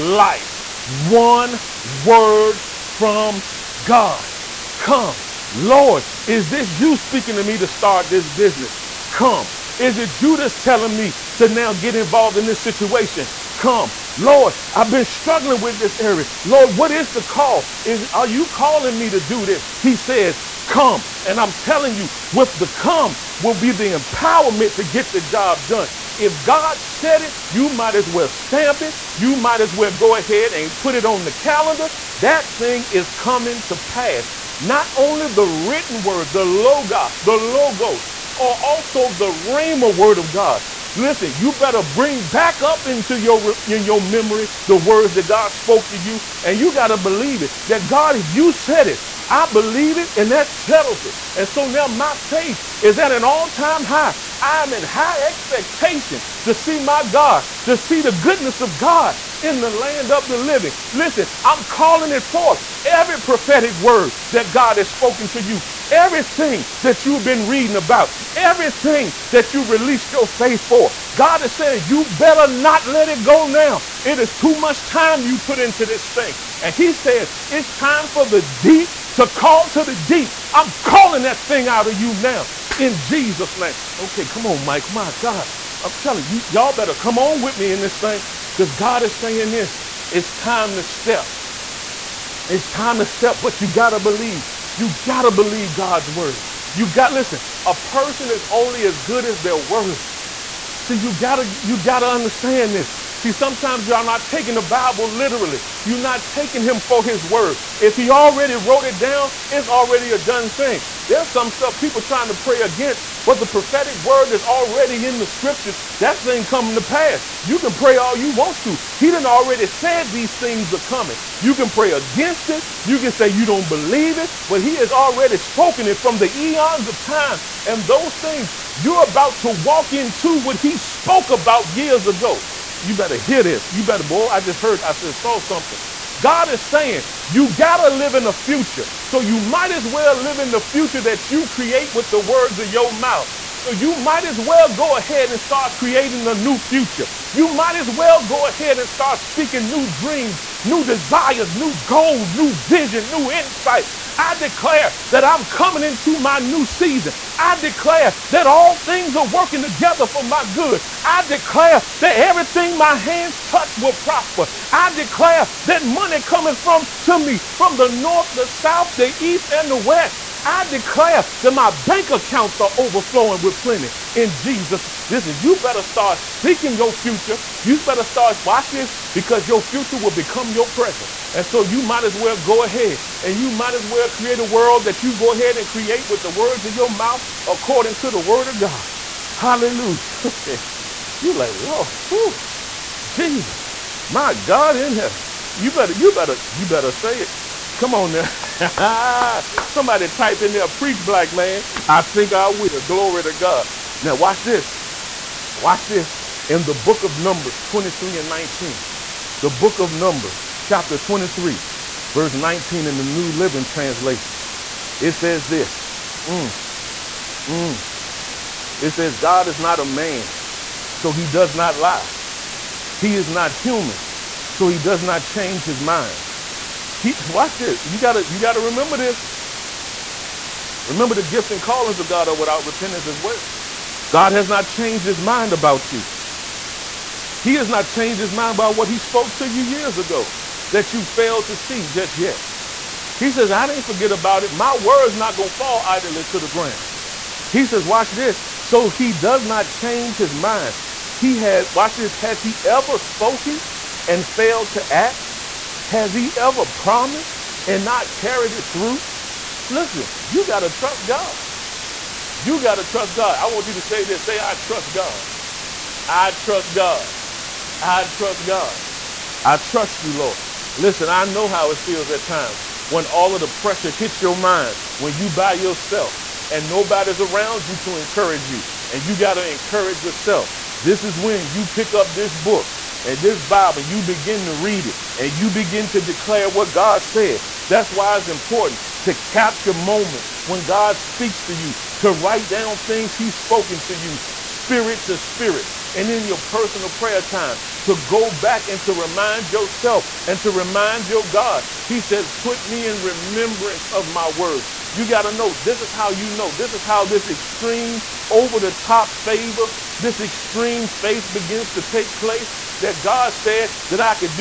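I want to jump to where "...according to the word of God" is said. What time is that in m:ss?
3:07.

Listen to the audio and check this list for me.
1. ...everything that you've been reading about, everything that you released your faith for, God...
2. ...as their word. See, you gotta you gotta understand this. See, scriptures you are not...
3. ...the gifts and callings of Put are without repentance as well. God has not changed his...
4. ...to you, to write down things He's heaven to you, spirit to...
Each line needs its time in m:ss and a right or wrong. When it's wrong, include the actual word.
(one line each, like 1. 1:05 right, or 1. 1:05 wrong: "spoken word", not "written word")
1. 1:05 right
2. 1:39 wrong: "sometimes", not "scriptures"
3. 3:51 wrong: "God", not "Put"
4. 4:51 wrong: "spoken", not "heaven".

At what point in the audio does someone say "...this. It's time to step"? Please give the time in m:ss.
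1:29.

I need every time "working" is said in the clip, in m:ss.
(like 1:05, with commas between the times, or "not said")
2:39.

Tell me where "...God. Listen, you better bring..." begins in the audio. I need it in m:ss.
0:40.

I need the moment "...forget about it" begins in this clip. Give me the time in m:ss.
4:03.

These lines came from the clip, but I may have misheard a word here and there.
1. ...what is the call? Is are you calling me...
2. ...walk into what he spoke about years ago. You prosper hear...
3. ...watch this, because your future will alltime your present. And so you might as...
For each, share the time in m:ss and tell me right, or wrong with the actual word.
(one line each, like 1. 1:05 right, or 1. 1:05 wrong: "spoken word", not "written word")
1. 0:16 right
2. 2:09 wrong: "better", not "prosper"
3. 2:58 wrong: "become", not "alltime".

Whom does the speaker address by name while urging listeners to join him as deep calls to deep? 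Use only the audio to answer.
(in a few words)
Mike.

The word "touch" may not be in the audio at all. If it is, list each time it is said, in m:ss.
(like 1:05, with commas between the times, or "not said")
2:43.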